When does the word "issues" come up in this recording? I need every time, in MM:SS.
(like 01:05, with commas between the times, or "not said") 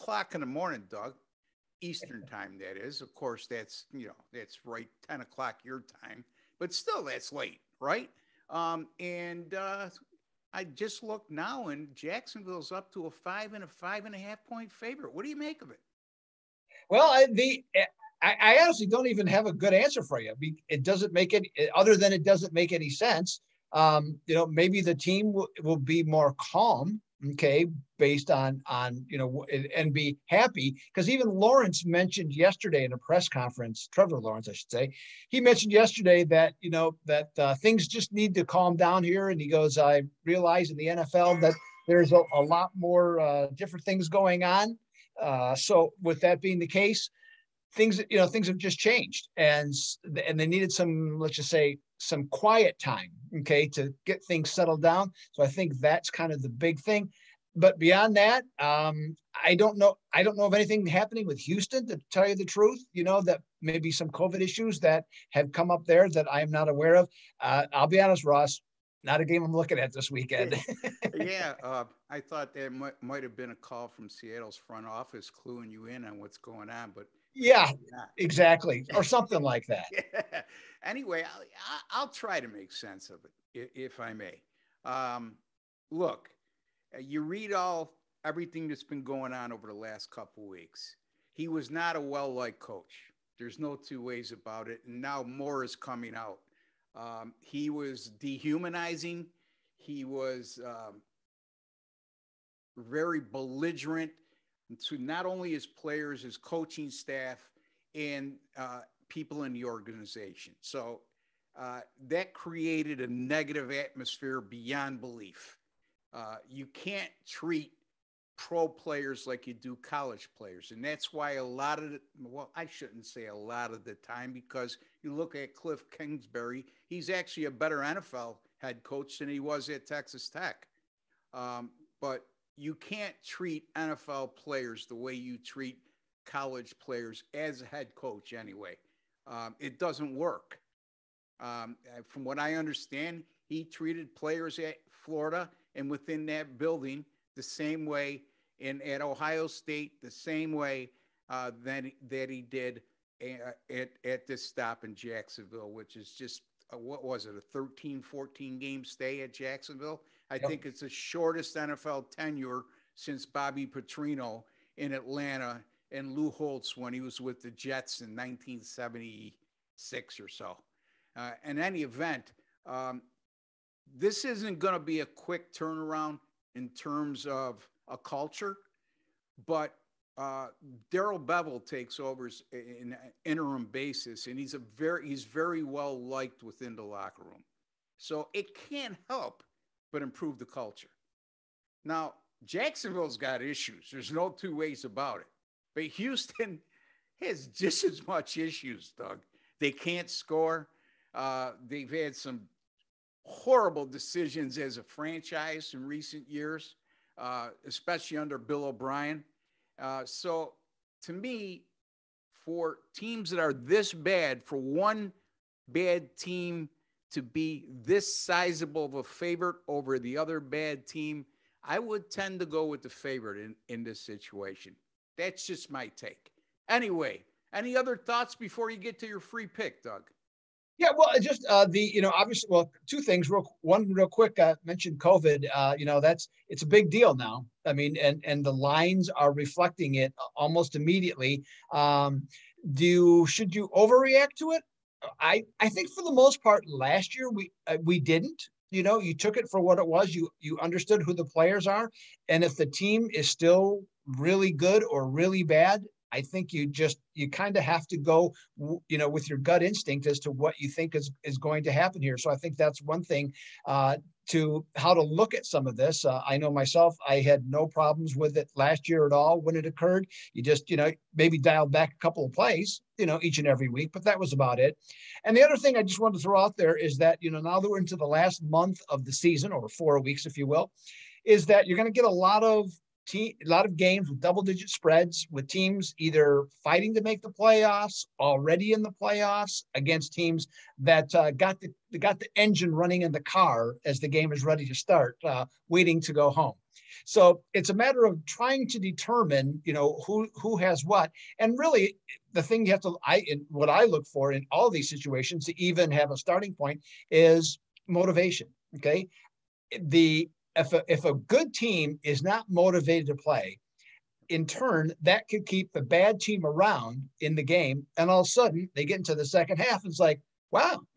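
01:04, 03:13, 03:18.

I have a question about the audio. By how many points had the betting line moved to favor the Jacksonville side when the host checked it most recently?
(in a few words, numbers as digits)
5.5.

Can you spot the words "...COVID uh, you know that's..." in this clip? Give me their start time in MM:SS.
03:54.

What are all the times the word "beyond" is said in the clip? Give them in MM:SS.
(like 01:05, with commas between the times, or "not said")
00:57, 01:54.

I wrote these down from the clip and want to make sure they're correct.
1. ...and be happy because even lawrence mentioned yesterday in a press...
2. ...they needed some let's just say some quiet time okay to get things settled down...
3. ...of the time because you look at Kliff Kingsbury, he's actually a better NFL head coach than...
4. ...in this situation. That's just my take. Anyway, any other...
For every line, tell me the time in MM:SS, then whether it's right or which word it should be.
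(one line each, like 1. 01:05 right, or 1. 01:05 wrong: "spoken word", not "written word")
1. 00:29 right
2. 00:50 right
3. 02:03 right
4. 03:43 right.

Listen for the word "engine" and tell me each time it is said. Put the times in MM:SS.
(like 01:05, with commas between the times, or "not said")
04:52.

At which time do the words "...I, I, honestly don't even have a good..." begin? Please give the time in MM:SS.
00:18.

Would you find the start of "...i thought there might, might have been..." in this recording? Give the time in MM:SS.
01:12.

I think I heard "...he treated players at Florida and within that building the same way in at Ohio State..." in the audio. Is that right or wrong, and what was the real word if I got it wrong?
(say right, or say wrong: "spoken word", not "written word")
right.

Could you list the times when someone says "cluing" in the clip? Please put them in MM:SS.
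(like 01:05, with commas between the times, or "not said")
01:15.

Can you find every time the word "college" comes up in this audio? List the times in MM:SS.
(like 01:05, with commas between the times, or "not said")
01:59, 02:16.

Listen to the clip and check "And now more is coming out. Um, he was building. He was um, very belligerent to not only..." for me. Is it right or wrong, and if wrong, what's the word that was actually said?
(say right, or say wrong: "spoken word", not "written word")
wrong: "dehumanizing", not "building".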